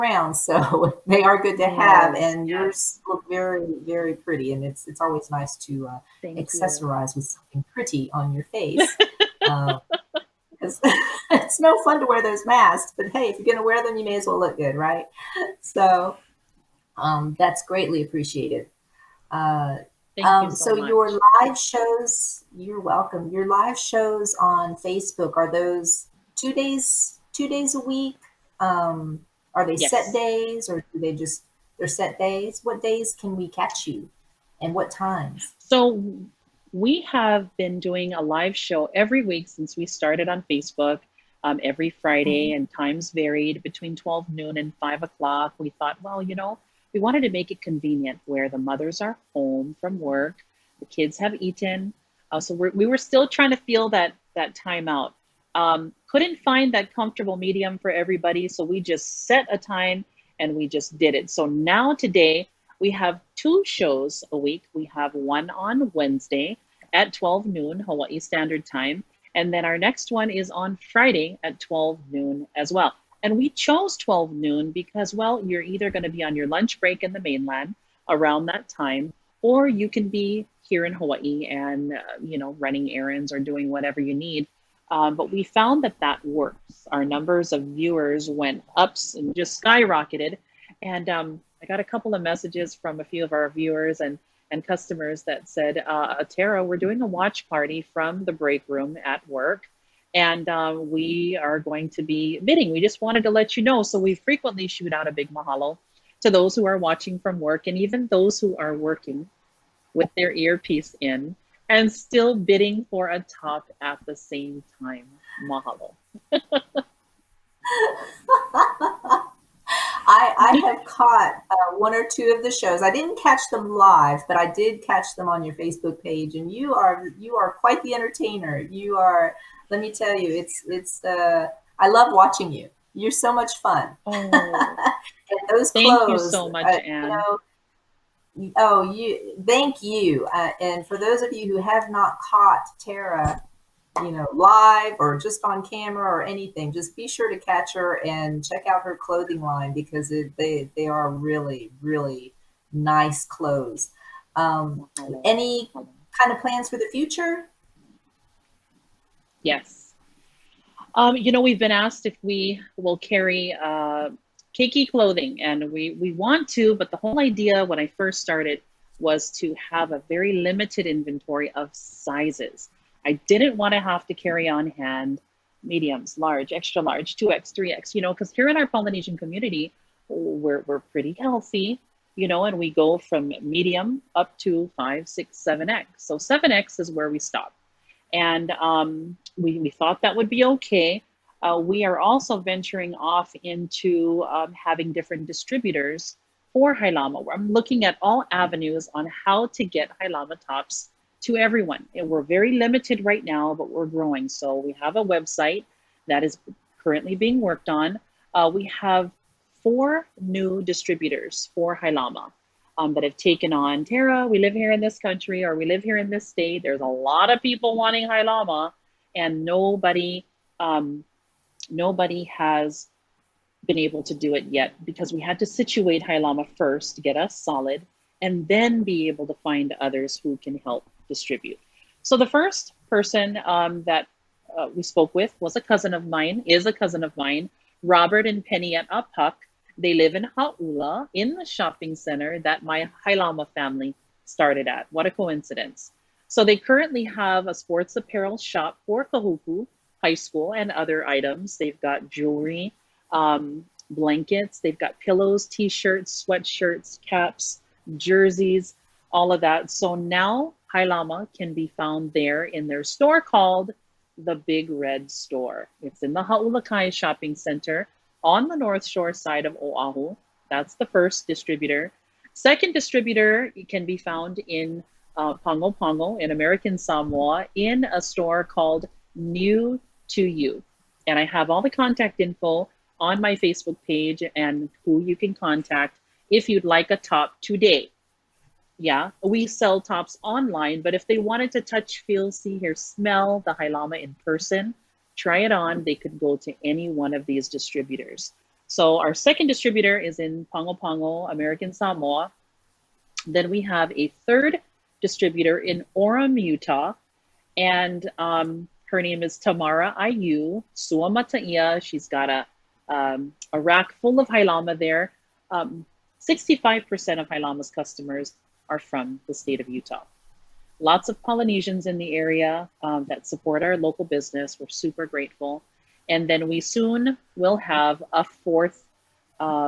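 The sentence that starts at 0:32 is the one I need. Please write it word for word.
What days can we catch you and what times?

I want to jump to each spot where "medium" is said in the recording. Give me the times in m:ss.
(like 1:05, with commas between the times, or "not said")
0:57, 2:55, 3:03.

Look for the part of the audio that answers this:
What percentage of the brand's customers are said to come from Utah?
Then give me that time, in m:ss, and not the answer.
5:16.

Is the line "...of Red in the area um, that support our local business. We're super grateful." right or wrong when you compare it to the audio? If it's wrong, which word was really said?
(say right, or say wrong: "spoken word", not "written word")
wrong: "Polynesians", not "Red".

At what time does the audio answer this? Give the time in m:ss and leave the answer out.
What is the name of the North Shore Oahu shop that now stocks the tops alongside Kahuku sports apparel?
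4:24.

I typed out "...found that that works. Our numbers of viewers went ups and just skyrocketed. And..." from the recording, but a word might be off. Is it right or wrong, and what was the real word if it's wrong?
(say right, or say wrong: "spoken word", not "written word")
right.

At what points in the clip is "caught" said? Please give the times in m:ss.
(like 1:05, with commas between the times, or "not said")
2:00, 2:22.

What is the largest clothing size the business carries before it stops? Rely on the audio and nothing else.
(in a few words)
7x.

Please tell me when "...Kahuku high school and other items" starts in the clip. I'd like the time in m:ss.
4:09.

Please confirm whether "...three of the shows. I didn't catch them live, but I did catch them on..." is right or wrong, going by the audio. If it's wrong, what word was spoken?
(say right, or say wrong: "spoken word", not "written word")
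wrong: "two", not "three".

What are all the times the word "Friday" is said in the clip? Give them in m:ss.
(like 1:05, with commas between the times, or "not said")
0:41, 1:10.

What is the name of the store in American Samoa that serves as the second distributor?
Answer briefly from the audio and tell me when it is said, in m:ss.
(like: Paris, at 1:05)
New to you, at 4:39.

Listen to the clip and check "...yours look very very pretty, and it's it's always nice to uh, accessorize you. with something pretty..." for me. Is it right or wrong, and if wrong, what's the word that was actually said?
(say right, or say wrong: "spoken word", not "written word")
right.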